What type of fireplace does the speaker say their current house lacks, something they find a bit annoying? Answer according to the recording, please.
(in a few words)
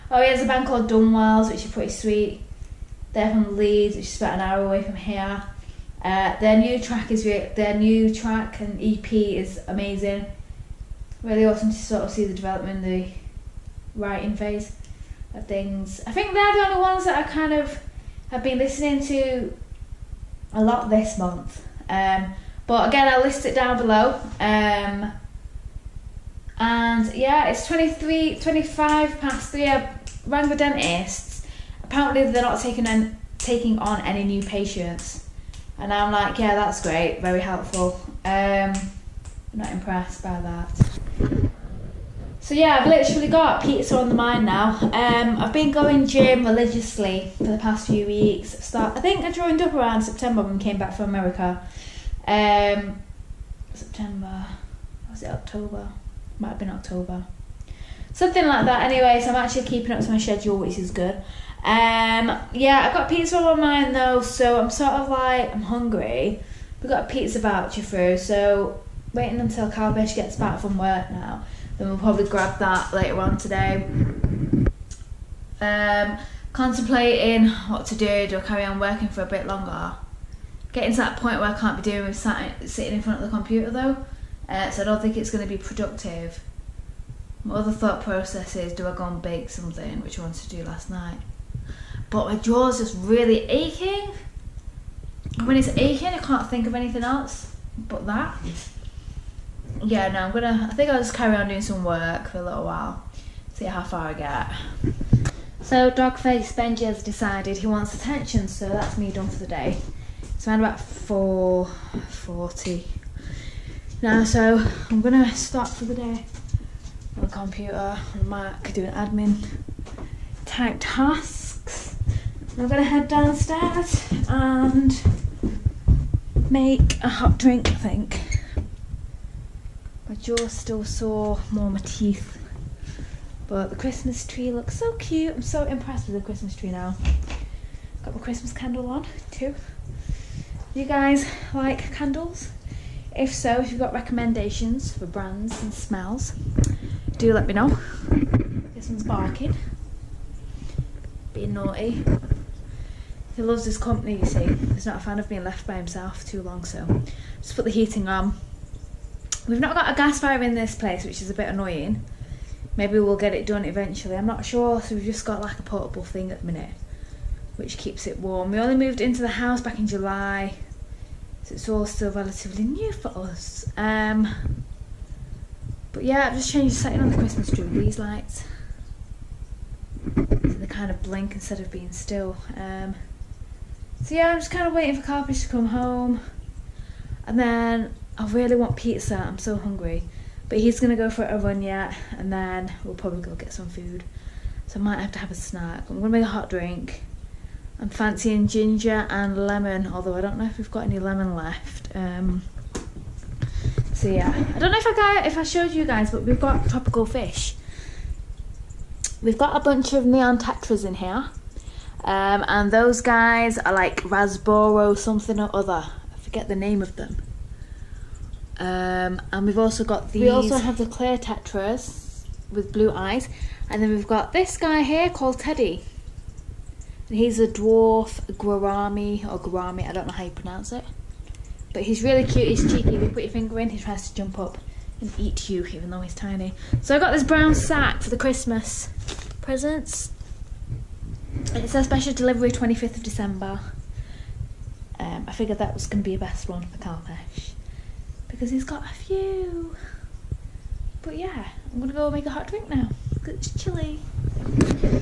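gas fire.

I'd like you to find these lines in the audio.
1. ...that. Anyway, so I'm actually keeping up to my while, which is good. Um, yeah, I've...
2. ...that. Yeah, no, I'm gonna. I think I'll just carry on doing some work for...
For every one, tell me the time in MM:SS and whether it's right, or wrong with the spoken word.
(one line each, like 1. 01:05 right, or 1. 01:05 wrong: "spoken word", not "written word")
1. 00:58 wrong: "schedule", not "while"
2. 01:38 right.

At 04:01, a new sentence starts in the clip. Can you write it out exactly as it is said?
It's a special delivery 25th of December.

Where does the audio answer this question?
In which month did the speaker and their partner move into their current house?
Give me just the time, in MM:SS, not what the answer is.
02:49.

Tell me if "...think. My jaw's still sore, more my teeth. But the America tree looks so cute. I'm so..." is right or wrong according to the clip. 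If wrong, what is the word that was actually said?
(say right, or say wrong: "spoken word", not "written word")
wrong: "Christmas", not "America".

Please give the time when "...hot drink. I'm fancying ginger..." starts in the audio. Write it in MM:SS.
03:16.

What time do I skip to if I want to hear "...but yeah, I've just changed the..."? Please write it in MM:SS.
02:55.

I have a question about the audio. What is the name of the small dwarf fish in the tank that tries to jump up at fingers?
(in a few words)
Teddy.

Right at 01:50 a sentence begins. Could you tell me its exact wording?
It's around about 4.40 now, so I'm gonna stop for the day on the computer, on the Mac, doing admin type tasks.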